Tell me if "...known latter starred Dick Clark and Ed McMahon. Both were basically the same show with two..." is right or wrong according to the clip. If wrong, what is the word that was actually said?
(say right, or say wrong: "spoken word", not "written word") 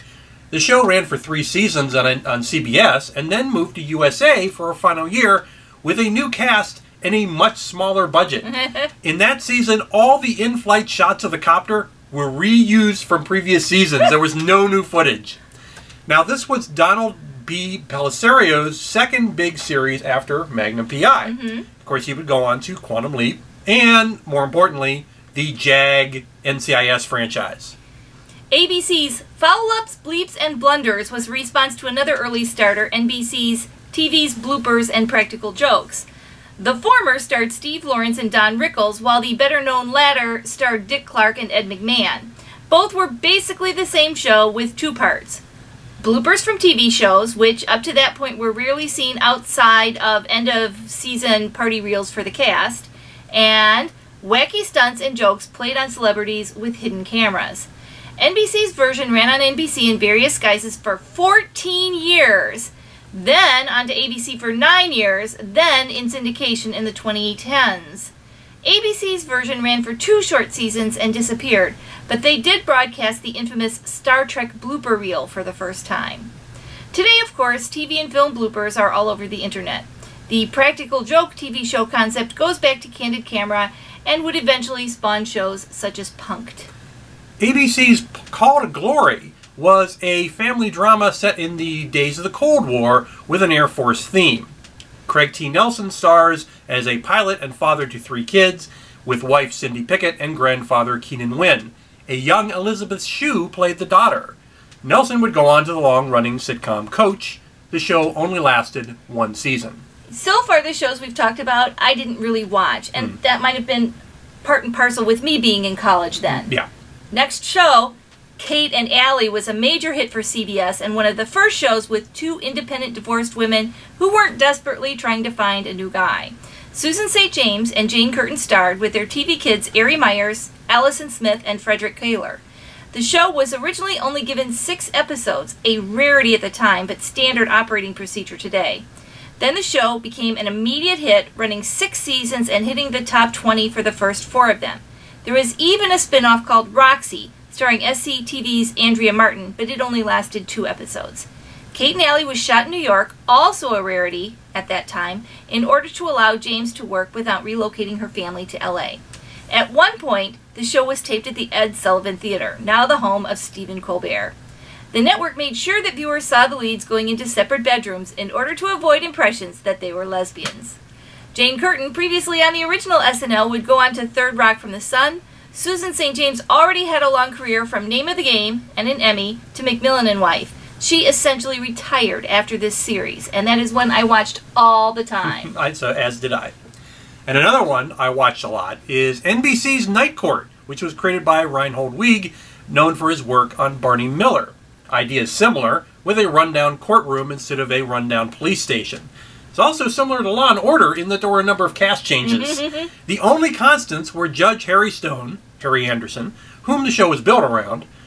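right.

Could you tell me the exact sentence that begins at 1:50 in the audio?
So far, the shows we've talked about, I didn't really watch, and mm.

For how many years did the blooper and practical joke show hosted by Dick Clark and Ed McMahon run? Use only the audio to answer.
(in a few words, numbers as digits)
9.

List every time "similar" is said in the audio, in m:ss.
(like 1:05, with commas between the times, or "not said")
3:15, 3:19.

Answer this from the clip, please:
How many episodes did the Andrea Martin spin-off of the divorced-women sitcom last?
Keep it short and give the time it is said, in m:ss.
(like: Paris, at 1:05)
2, at 2:30.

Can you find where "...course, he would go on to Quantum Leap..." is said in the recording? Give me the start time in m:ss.
0:21.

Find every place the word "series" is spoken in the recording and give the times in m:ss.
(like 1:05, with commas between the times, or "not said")
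0:19, 3:02.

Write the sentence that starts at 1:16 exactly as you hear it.
Today, of course, TV and film bloopers are all over the internet.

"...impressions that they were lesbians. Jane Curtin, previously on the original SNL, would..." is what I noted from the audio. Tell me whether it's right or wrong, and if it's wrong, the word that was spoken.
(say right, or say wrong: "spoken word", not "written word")
right.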